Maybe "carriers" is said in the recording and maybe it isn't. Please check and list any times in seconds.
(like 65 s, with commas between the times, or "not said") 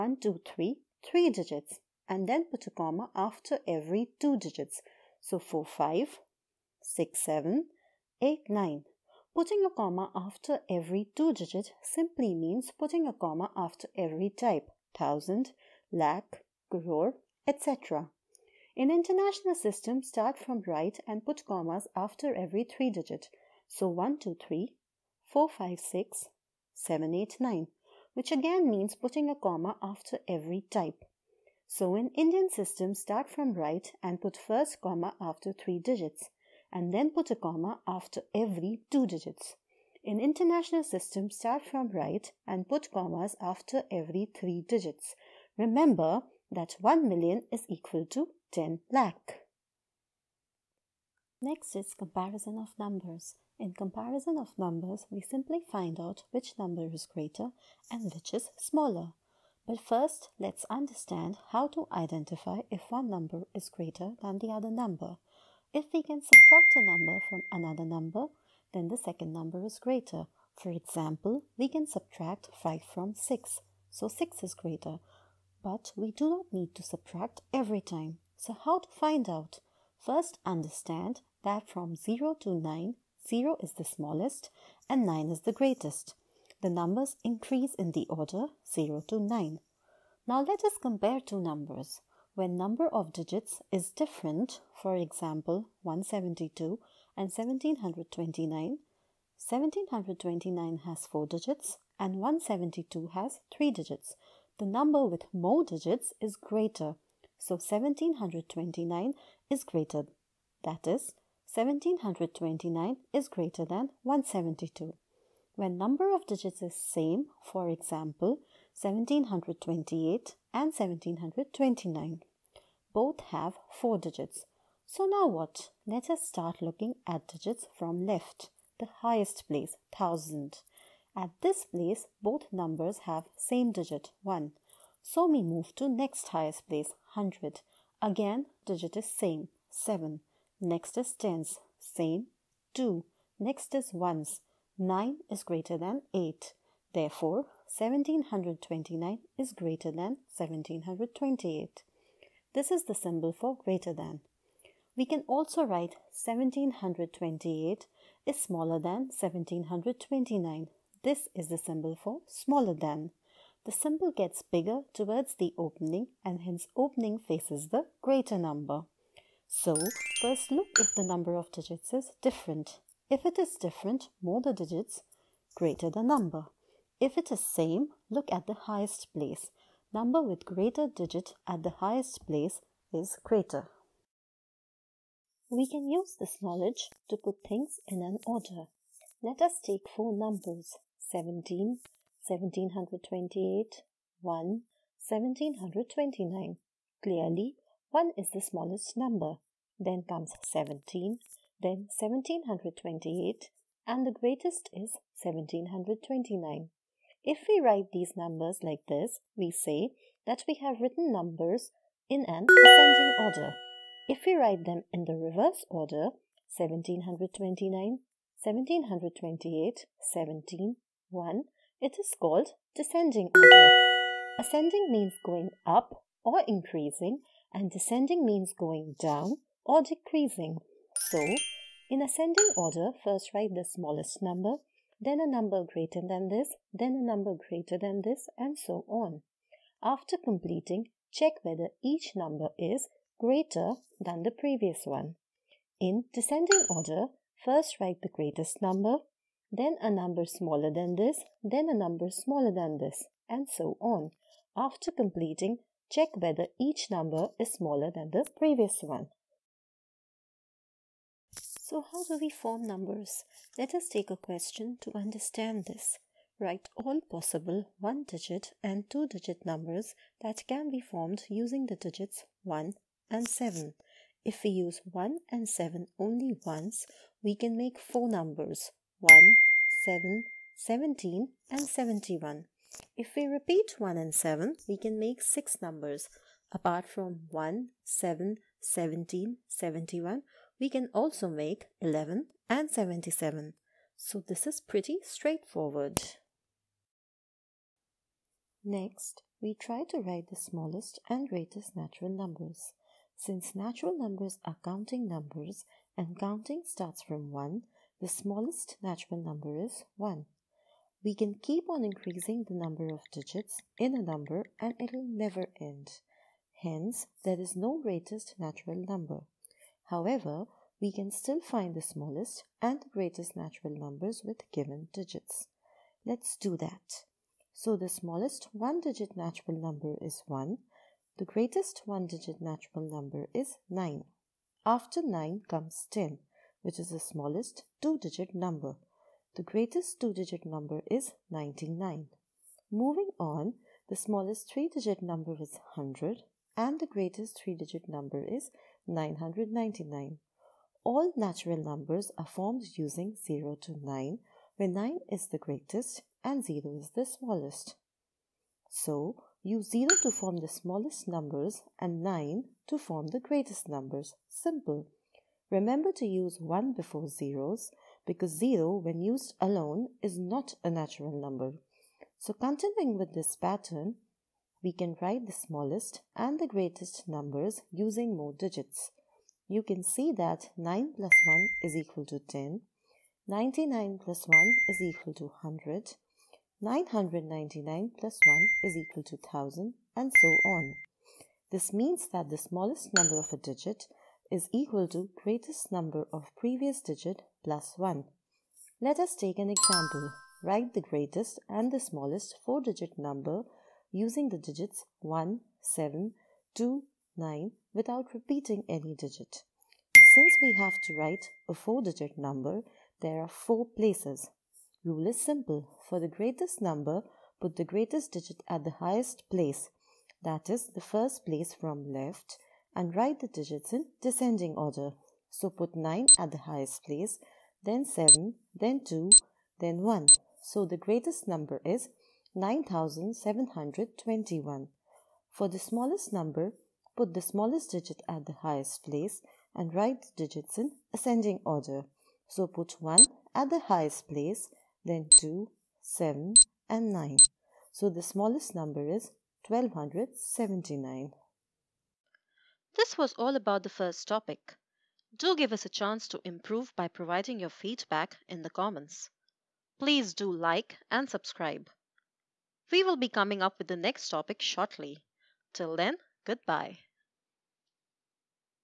not said.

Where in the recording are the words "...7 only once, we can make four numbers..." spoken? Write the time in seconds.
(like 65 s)
275 s.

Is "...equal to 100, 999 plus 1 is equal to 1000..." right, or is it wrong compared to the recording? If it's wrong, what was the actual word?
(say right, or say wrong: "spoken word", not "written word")
right.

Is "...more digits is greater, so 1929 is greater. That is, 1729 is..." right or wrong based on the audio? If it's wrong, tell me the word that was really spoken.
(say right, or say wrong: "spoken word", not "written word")
wrong: "1729", not "1929".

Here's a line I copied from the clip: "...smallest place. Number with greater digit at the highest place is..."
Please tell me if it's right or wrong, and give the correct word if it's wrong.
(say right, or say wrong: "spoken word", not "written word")
wrong: "highest", not "smallest".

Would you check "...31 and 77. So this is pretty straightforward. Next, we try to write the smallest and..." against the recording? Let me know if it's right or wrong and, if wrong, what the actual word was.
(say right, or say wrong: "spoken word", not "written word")
wrong: "11", not "31".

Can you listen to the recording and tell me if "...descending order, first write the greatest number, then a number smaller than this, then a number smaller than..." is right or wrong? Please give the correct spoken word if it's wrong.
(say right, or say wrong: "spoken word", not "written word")
right.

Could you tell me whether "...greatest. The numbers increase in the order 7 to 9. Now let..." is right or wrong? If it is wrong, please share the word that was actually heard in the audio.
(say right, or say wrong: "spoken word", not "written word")
wrong: "0", not "7".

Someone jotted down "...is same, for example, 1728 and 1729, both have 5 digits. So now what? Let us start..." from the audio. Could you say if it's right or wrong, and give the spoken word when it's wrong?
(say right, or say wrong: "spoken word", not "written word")
wrong: "4", not "5".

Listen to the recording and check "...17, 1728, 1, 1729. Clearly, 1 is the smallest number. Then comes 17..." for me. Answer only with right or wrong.
right.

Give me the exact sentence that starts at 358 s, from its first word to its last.
So, use 0 to form the smallest numbers and 9 to form the greatest numbers.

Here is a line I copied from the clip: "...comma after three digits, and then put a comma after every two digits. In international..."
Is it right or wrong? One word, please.
right.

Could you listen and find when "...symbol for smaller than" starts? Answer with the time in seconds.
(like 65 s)
161 s.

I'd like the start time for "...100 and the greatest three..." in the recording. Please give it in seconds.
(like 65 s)
345 s.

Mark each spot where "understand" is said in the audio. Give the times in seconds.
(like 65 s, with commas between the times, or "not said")
60 s, 80 s, 264 s.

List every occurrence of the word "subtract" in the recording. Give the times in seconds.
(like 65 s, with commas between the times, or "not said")
66 s, 71 s, 76 s.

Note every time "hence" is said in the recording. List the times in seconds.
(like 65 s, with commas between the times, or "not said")
166 s, 316 s.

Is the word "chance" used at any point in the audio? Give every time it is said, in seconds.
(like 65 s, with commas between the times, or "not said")
455 s.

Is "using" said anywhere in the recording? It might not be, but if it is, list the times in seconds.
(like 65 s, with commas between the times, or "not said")
271 s, 352 s, 377 s, 403 s.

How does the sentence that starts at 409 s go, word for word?
Since we have to write a 4-digit number, there are 4 places.